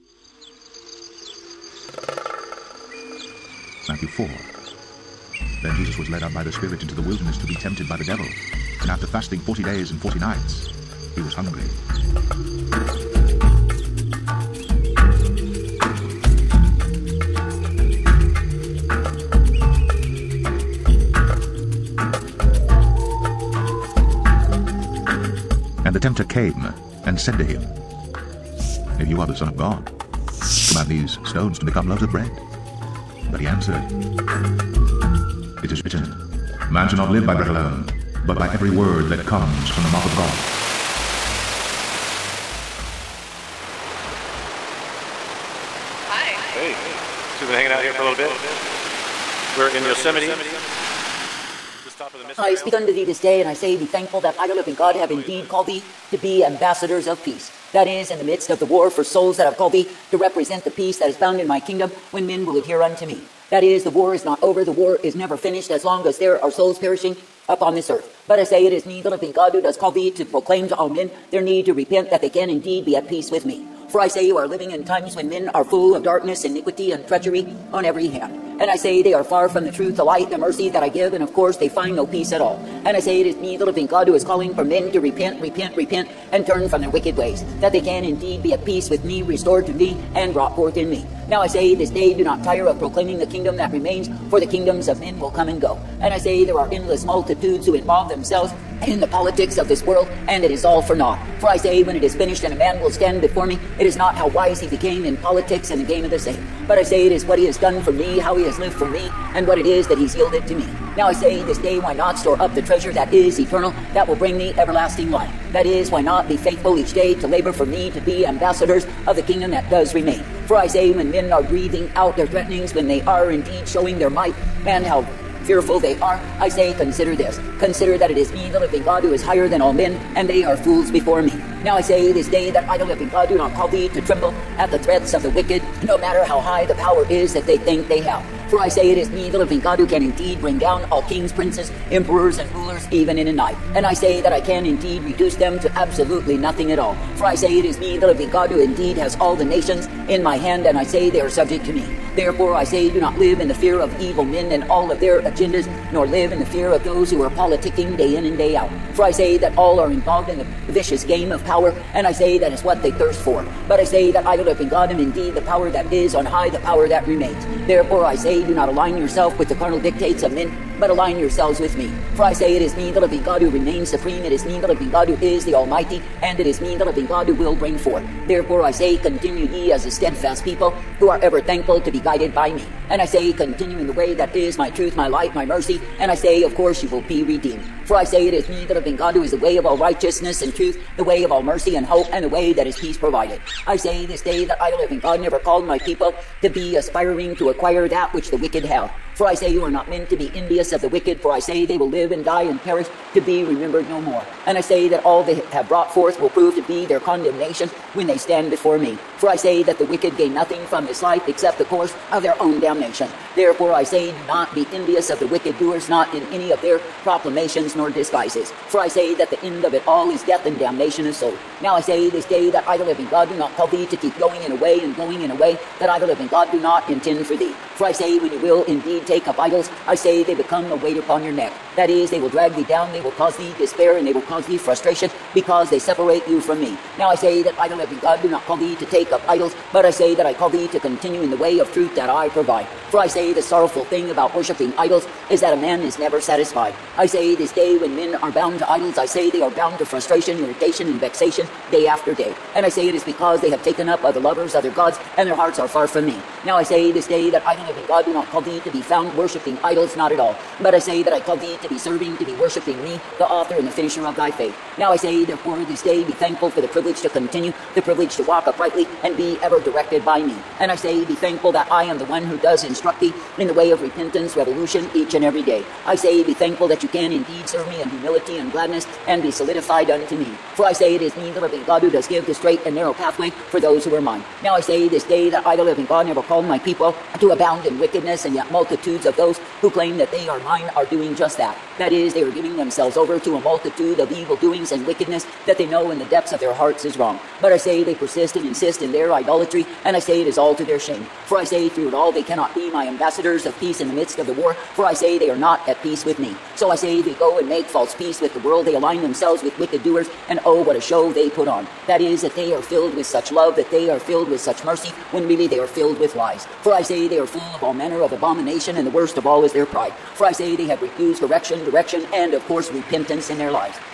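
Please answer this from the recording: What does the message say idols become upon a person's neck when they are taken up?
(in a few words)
A weight.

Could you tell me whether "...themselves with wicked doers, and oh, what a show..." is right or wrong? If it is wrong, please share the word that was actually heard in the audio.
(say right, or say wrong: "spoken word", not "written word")
right.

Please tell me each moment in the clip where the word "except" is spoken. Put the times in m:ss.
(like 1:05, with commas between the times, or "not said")
3:31.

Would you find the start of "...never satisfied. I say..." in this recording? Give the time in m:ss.
4:05.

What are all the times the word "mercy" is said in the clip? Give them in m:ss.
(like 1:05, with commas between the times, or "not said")
1:20, 3:05, 3:11, 5:14.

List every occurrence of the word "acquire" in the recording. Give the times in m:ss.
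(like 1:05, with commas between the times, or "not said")
3:17.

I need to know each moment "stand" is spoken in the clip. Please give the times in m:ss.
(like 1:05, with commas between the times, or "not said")
1:42, 3:28.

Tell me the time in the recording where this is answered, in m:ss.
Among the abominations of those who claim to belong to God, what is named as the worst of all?
5:19.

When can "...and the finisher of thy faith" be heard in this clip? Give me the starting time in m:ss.
4:23.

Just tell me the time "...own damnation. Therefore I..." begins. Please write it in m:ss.
3:32.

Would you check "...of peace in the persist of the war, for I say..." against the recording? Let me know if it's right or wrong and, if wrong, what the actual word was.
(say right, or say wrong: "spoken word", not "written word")
wrong: "midst", not "persist".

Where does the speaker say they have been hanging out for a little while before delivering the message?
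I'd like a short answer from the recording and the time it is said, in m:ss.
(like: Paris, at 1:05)
Yosemite, at 0:49.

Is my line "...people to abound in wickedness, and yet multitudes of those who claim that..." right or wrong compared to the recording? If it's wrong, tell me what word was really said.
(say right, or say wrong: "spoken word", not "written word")
right.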